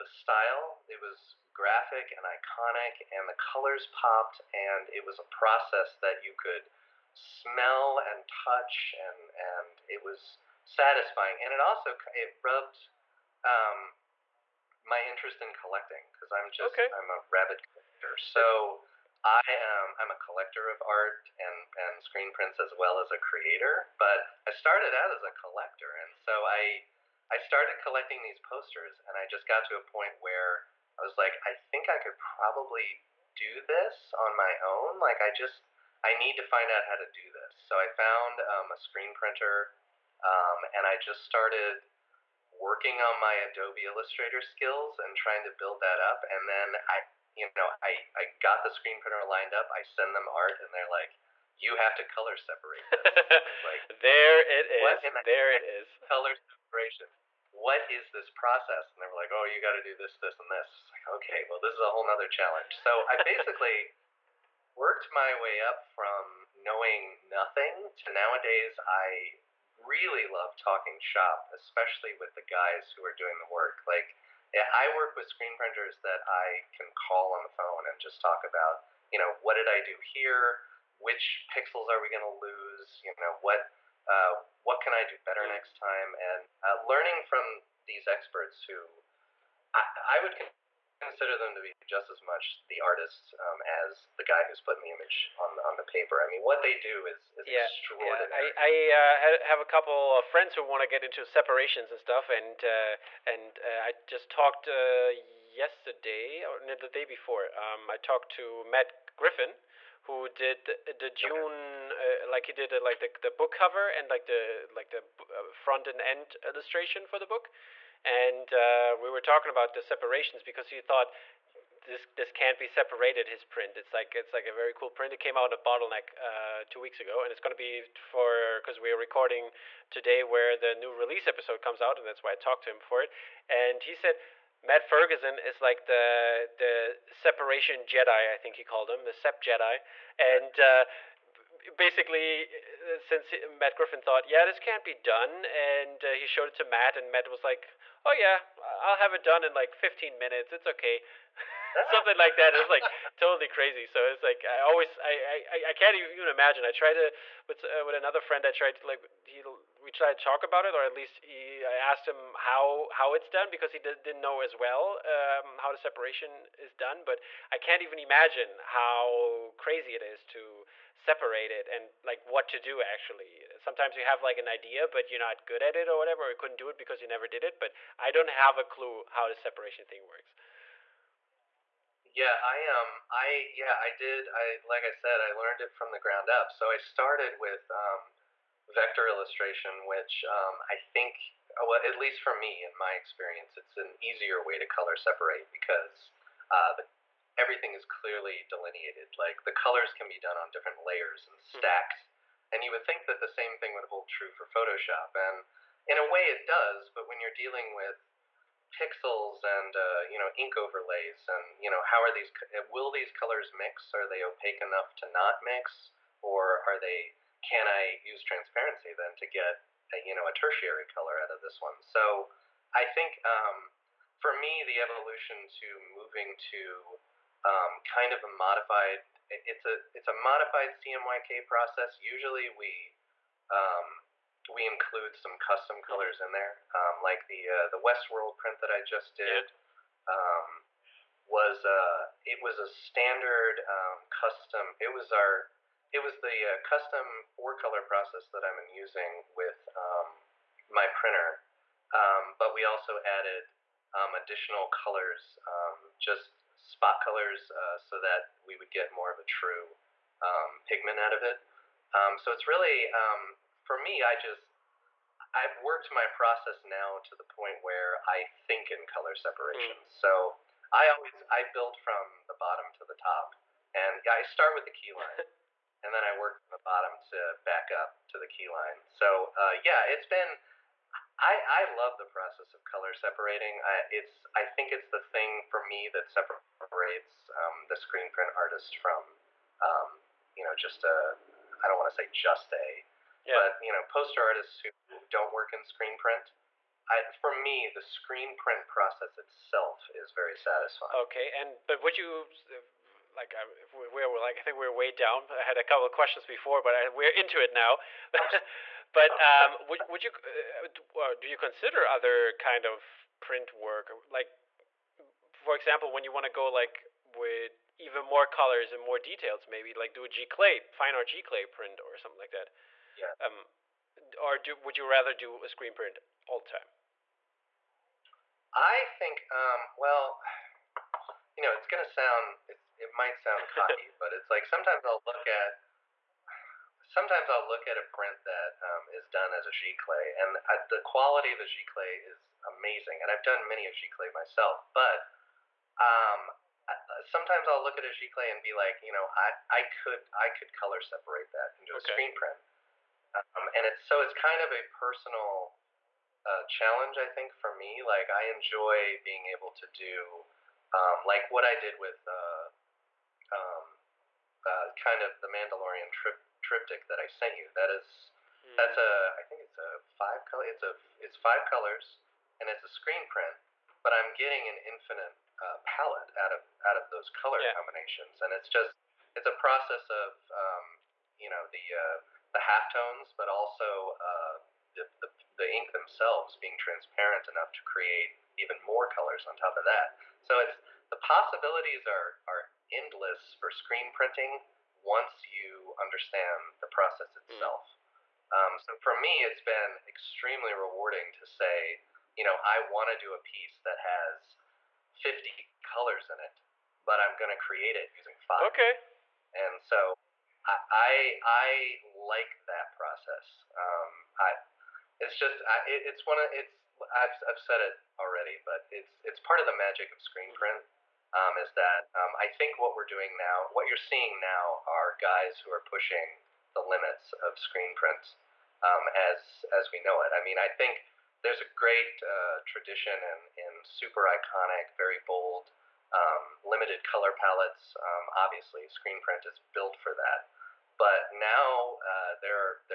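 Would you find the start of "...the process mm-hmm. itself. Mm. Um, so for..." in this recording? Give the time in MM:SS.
06:36.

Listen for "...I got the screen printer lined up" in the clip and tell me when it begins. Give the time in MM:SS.
00:48.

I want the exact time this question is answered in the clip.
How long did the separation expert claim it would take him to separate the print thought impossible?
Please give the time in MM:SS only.
02:29.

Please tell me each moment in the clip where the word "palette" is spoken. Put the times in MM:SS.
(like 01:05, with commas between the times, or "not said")
06:15, 07:17.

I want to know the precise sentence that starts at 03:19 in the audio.
Like the colors can be done on different layers and mm-hmm.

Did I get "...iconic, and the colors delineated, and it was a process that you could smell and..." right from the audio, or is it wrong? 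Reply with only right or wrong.
wrong.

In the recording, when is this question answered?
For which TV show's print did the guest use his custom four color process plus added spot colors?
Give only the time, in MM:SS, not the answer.
03:57.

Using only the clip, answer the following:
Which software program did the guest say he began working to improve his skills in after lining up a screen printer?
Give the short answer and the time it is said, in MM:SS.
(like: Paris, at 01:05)
Adobe Illustrator, at 00:43.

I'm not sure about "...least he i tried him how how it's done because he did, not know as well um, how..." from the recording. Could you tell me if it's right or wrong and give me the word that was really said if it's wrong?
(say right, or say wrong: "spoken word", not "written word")
wrong: "asked", not "tried".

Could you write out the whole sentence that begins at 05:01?
Okay, and but would you like I, we are like I think we are way down.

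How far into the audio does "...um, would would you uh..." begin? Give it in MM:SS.
05:09.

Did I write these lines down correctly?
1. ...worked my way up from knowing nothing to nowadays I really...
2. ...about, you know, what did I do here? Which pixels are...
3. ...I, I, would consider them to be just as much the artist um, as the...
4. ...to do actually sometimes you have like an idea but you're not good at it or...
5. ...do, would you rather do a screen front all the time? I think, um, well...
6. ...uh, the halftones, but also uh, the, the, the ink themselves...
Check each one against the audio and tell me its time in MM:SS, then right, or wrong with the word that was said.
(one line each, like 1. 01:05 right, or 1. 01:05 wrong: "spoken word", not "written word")
1. 01:04 right
2. 01:18 right
3. 01:29 right
4. 02:52 right
5. 05:24 wrong: "print", not "front"
6. 06:21 right.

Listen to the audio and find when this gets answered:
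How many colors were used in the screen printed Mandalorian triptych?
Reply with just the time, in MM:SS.
06:11.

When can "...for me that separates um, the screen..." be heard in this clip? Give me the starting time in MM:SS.
04:45.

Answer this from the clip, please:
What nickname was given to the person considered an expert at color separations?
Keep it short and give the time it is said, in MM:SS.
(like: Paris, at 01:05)
Sep Jedi, at 02:19.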